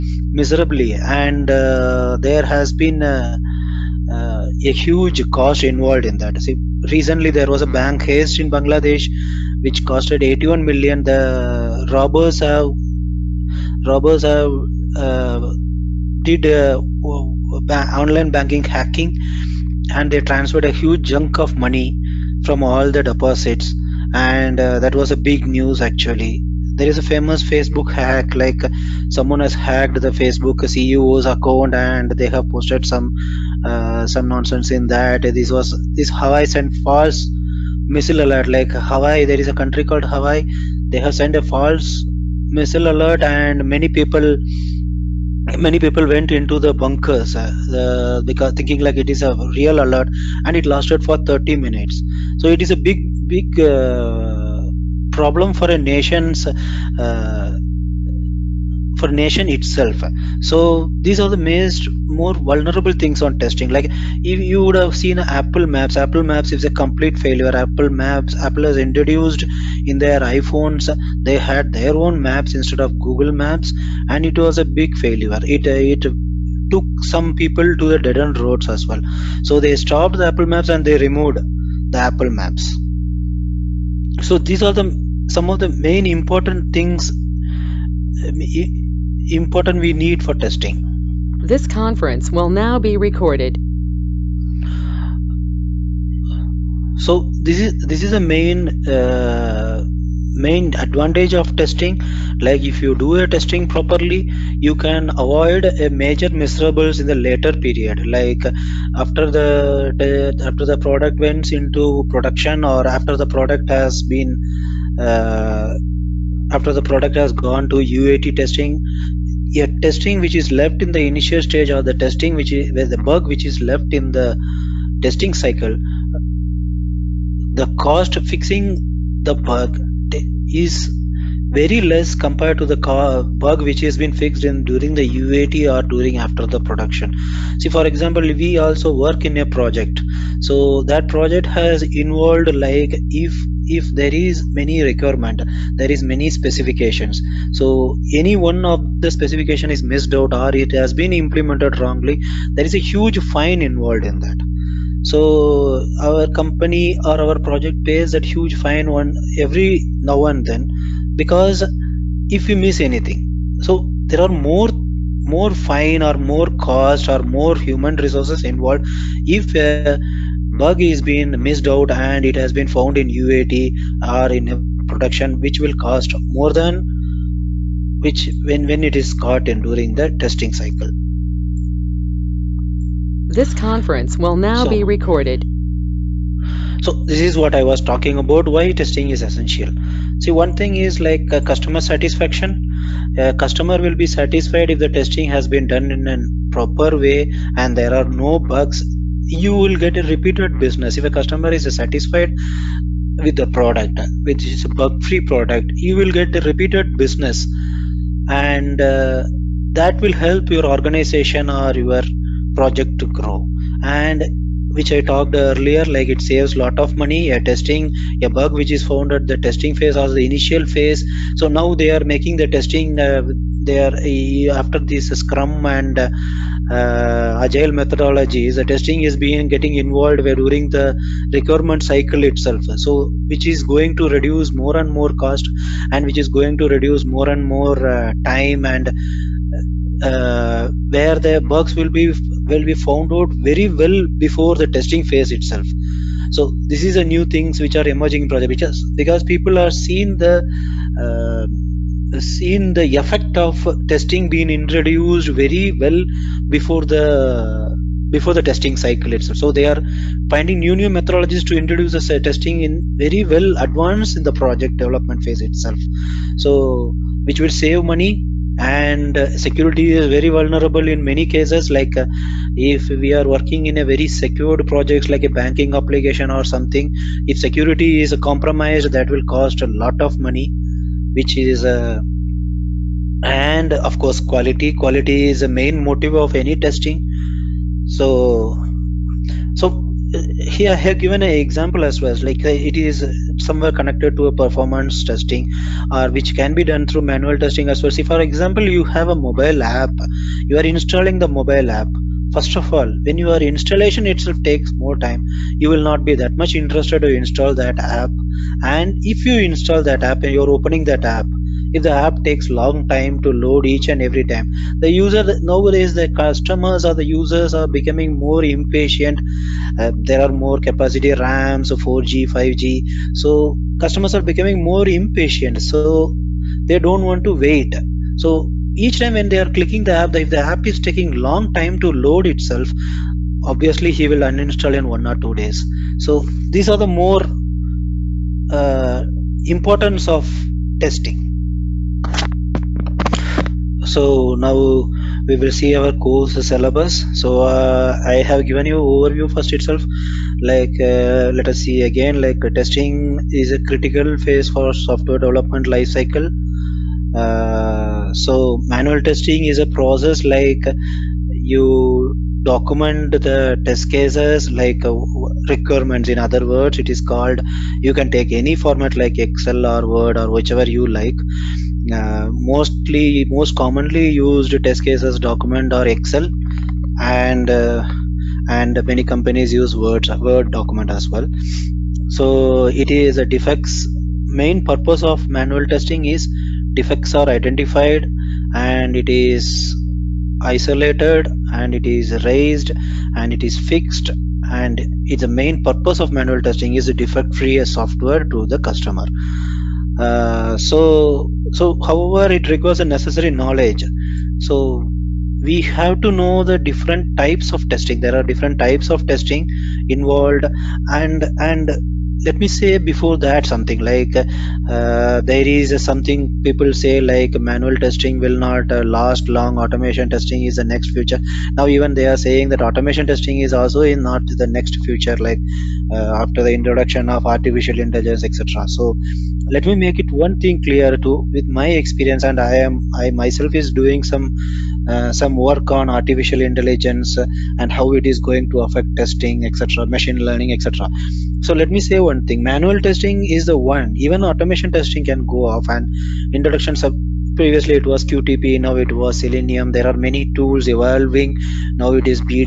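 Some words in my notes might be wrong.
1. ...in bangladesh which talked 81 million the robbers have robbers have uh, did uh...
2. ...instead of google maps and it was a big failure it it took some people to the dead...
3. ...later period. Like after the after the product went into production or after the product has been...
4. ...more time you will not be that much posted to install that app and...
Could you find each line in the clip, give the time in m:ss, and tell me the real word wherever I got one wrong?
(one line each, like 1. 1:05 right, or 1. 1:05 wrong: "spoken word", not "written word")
1. 0:08 wrong: "costed", not "talked"
2. 1:12 right
3. 1:47 right
4. 5:04 wrong: "interested", not "posted".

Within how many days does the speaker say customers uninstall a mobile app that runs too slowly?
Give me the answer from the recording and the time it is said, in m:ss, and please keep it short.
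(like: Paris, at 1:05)
1 or 2 days, at 5:34.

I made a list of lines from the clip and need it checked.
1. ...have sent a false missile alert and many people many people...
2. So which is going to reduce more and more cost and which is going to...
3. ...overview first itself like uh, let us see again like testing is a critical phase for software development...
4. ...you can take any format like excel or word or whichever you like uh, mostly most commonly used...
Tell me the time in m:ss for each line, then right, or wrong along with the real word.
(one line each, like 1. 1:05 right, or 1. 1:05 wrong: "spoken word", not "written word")
1. 0:40 right
2. 3:52 right
3. 5:48 right
4. 6:07 right.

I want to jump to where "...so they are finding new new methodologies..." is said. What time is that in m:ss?
4:19.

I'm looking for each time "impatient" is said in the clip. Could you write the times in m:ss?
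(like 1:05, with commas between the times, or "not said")
5:18, 5:24.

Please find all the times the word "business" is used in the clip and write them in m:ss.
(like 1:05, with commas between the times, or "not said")
3:20, 3:26.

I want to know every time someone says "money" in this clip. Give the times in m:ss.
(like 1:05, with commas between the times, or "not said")
0:21, 3:36, 4:27, 4:40.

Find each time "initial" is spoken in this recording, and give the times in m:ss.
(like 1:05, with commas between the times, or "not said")
2:01, 3:40.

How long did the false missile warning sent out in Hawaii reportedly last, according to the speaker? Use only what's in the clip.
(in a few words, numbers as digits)
30 minutes.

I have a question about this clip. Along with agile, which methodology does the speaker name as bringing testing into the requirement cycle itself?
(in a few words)
Scrum.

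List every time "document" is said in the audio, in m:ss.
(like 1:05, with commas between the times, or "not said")
6:02, 6:15, 6:20.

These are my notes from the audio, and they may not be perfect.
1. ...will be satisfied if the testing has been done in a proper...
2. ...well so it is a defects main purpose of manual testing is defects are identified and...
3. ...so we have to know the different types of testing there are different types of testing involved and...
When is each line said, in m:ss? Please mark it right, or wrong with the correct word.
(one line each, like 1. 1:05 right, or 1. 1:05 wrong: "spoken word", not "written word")
1. 3:13 right
2. 6:21 right
3. 6:44 right.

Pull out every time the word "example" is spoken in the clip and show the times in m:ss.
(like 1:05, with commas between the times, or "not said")
2:17, 4:51, 4:58.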